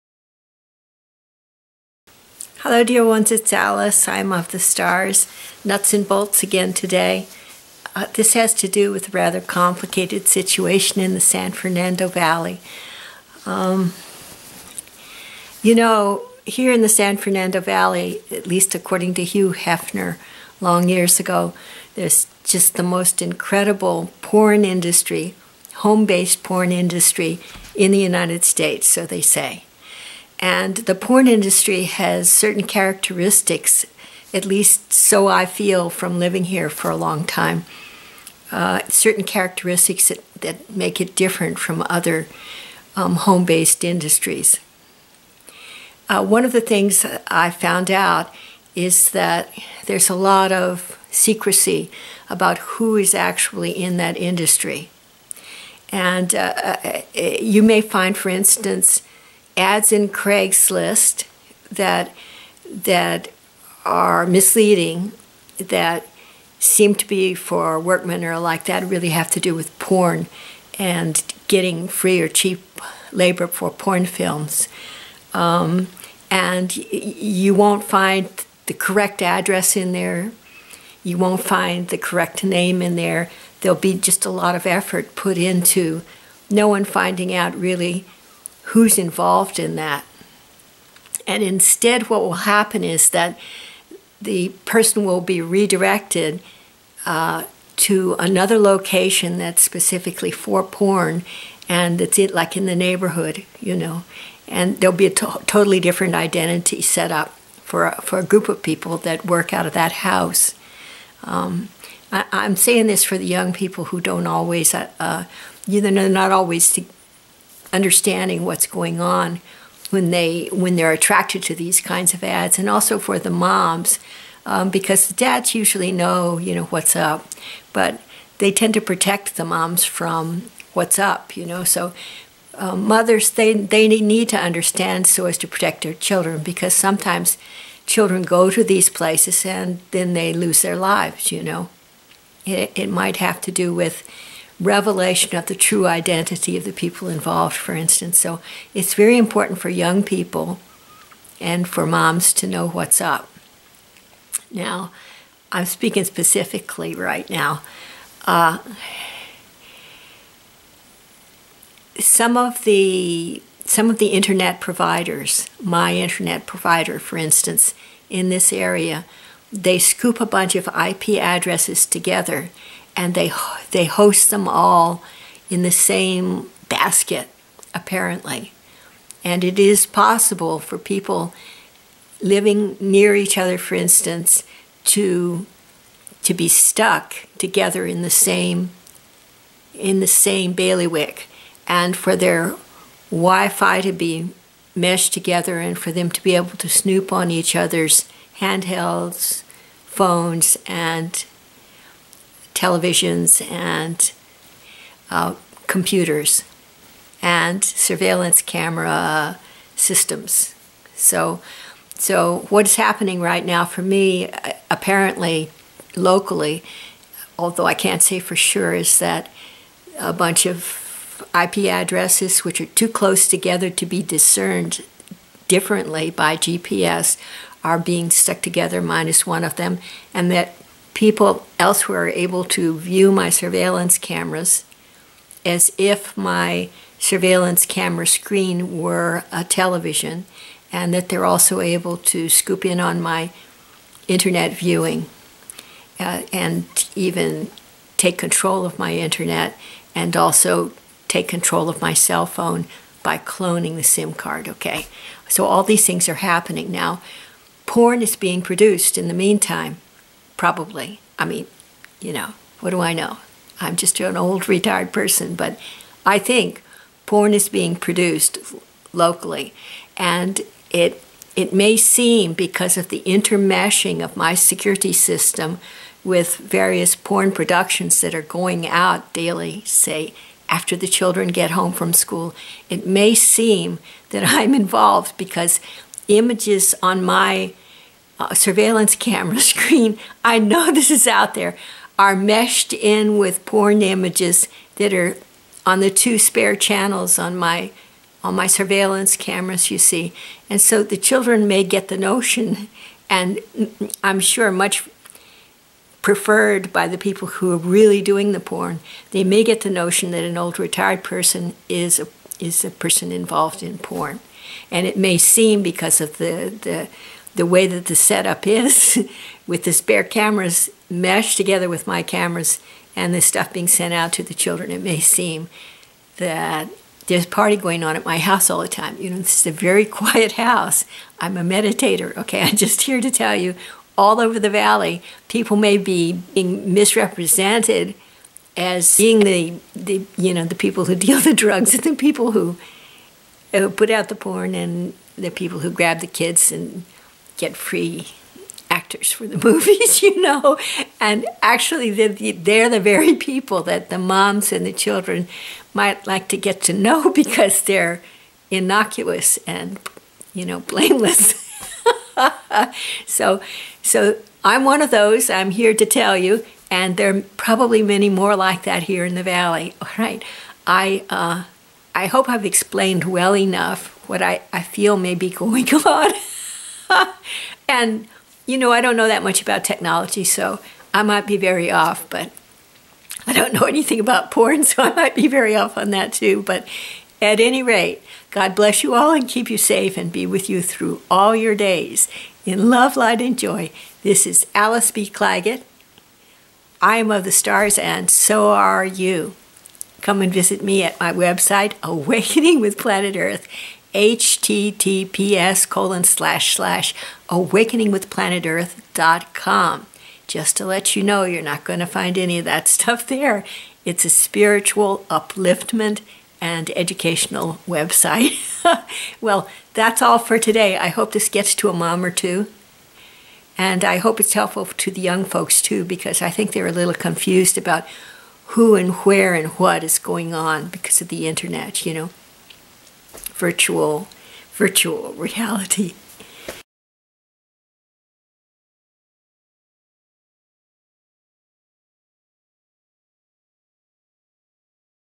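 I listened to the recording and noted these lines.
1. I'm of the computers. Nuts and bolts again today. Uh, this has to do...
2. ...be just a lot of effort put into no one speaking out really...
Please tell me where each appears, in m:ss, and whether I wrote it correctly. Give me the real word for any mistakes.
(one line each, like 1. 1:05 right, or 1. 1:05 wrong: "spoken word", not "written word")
1. 0:04 wrong: "stars", not "computers"
2. 1:23 wrong: "finding", not "speaking".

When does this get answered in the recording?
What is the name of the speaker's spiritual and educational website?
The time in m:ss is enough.
6:41.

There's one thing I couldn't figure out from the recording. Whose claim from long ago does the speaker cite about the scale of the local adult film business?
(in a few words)
Hugh Hefner.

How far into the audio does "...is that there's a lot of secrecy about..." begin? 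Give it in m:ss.
0:48.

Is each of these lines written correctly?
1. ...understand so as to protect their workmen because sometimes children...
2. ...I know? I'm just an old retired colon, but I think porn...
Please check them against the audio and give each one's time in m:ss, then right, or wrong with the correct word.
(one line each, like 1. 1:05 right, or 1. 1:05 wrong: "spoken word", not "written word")
1. 2:14 wrong: "children", not "workmen"
2. 4:22 wrong: "person", not "colon".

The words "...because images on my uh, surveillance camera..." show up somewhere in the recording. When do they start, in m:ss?
4:45.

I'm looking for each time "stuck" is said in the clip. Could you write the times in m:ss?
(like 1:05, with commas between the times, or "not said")
3:06, 3:48.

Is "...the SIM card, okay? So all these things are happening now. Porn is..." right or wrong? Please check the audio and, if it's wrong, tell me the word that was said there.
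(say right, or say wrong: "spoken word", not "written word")
right.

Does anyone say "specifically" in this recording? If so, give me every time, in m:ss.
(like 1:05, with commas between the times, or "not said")
1:39, 2:36.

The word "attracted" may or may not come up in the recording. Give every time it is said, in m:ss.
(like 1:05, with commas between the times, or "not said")
2:00.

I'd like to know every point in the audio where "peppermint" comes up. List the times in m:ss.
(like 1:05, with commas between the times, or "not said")
not said.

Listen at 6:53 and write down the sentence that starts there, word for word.
It's a spiritual upliftment and educational website.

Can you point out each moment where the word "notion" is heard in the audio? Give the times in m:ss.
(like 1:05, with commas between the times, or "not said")
5:01, 5:09.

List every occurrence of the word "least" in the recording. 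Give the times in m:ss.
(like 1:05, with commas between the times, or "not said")
0:18, 0:34.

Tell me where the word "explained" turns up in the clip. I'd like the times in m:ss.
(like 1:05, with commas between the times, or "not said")
6:12.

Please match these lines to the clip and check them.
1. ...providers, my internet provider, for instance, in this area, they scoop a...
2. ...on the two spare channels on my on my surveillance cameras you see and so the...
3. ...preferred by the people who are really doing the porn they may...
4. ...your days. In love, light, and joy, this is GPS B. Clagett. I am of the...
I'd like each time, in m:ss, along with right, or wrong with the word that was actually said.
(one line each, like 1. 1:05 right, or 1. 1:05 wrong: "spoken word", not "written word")
1. 2:44 right
2. 4:55 right
3. 5:06 right
4. 6:31 wrong: "Alice", not "GPS".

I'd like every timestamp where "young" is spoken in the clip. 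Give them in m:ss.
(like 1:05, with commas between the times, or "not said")
1:53, 2:29, 7:05.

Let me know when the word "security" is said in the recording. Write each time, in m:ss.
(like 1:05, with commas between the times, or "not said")
4:34.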